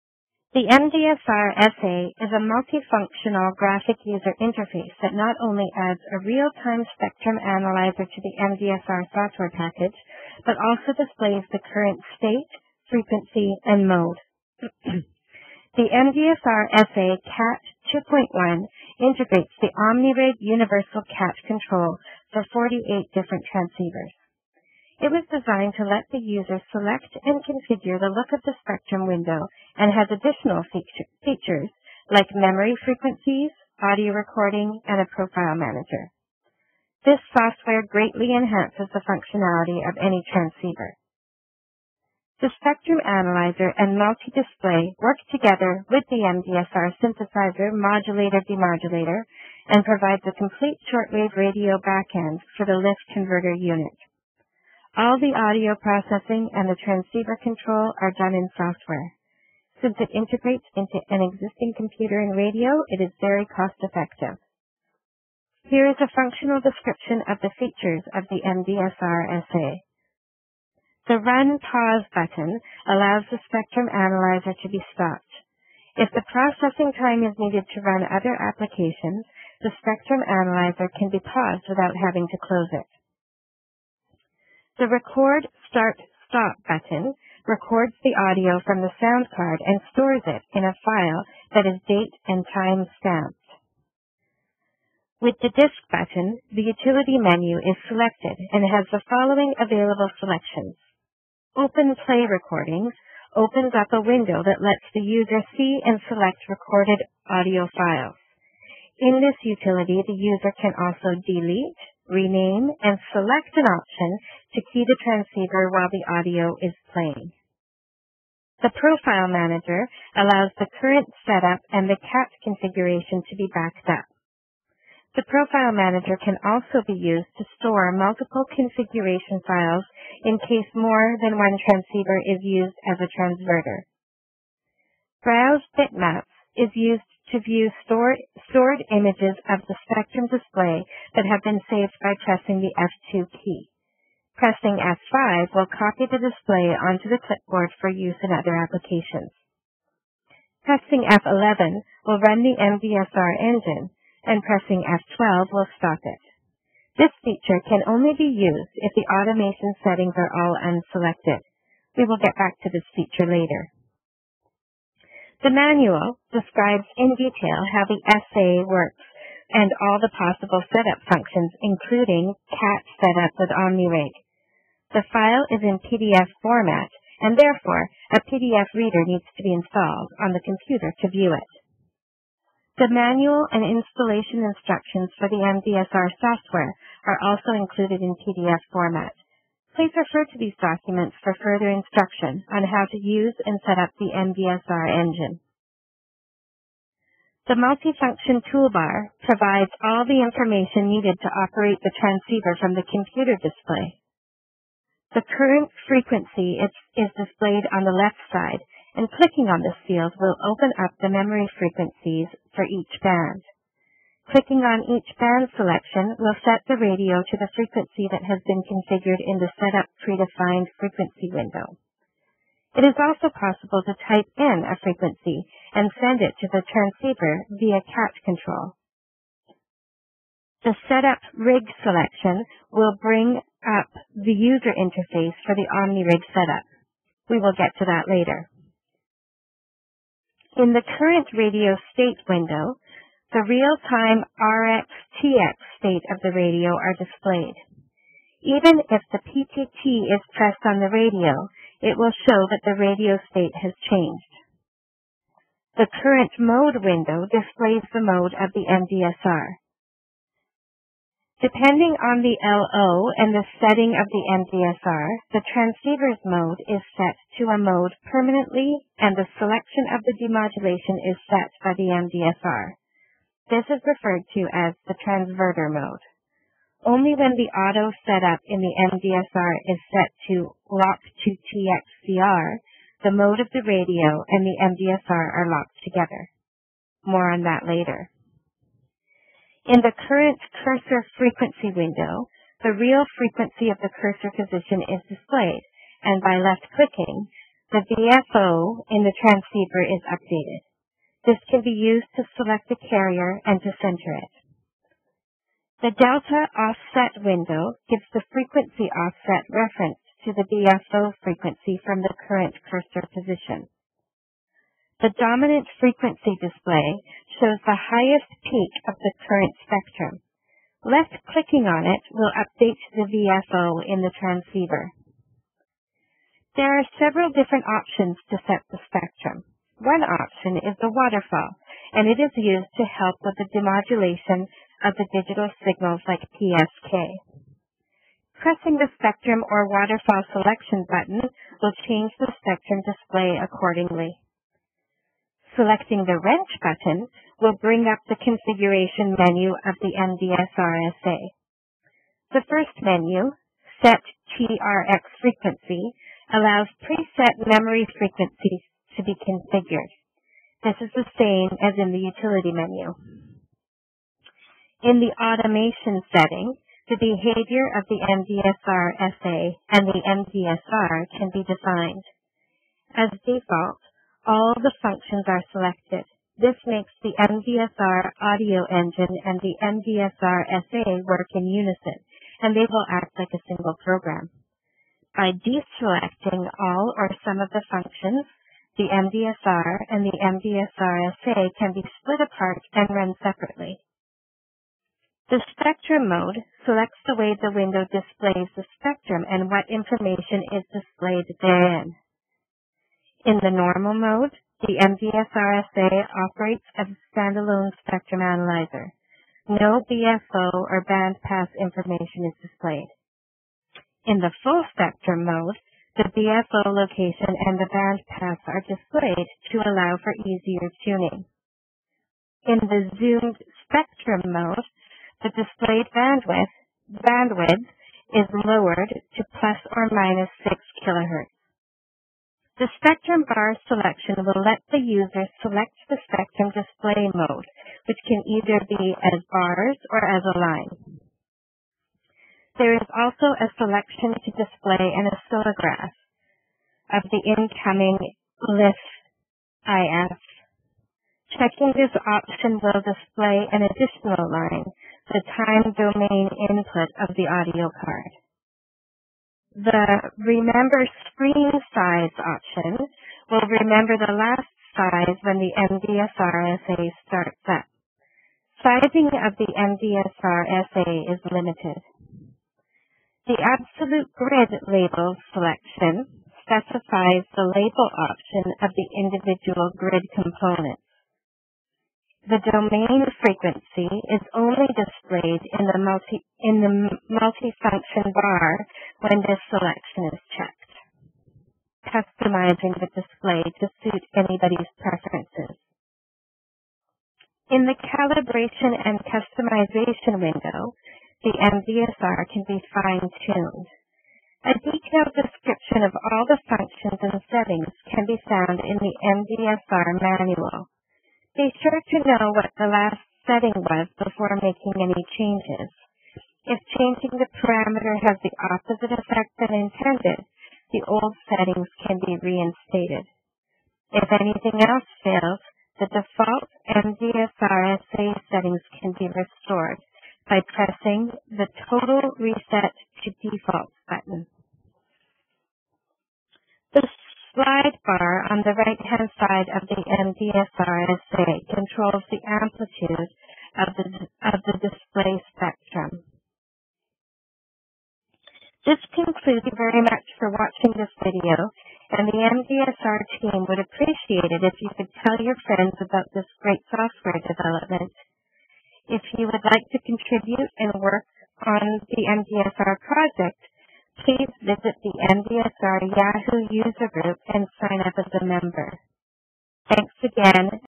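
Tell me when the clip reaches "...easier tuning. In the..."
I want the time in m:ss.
7:00.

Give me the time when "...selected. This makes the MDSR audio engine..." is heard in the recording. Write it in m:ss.
6:15.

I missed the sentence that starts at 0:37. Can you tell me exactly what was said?
This software greatly enhances the functionality of any transceiver.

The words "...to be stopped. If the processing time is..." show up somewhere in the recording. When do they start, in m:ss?
1:14.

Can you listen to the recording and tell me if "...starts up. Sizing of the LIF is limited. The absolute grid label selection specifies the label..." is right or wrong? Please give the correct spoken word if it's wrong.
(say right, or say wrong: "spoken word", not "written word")
wrong: "MDSR", not "LIF".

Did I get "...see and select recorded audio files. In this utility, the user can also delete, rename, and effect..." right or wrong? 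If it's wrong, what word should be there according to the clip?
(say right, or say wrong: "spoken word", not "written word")
wrong: "select", not "effect".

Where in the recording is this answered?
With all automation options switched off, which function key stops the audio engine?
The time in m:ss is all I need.
2:34.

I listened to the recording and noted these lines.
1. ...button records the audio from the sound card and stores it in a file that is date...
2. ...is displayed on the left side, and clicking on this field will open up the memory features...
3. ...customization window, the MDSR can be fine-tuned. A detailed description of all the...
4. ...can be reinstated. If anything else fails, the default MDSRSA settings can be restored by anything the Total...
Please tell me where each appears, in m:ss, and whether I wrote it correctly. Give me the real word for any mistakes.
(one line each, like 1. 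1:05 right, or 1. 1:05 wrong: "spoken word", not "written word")
1. 1:26 right
2. 3:26 wrong: "frequencies", not "features"
3. 8:19 right
4. 8:41 wrong: "pressing", not "anything".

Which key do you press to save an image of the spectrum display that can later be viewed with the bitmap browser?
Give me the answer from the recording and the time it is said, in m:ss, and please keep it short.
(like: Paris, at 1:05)
F2, at 2:22.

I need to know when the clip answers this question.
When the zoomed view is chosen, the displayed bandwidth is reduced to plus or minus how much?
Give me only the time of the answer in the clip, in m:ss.
7:10.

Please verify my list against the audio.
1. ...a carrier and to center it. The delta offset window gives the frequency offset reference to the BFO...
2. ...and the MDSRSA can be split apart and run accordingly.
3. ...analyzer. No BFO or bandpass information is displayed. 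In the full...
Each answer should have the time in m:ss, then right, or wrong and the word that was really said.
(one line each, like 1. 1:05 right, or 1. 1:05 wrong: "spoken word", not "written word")
1. 5:02 right
2. 6:29 wrong: "separately", not "accordingly"
3. 6:48 right.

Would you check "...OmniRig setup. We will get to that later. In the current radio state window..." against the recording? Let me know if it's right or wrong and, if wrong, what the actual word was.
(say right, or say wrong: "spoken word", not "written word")
right.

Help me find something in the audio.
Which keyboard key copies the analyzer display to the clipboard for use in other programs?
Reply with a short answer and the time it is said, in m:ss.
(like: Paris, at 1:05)
F5, at 2:24.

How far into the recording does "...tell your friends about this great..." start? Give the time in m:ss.
9:15.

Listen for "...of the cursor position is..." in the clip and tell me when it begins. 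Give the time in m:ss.
4:53.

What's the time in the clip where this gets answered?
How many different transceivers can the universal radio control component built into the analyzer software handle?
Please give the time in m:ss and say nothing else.
0:22.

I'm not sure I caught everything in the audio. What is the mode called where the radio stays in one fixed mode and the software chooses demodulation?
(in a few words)
transverter mode.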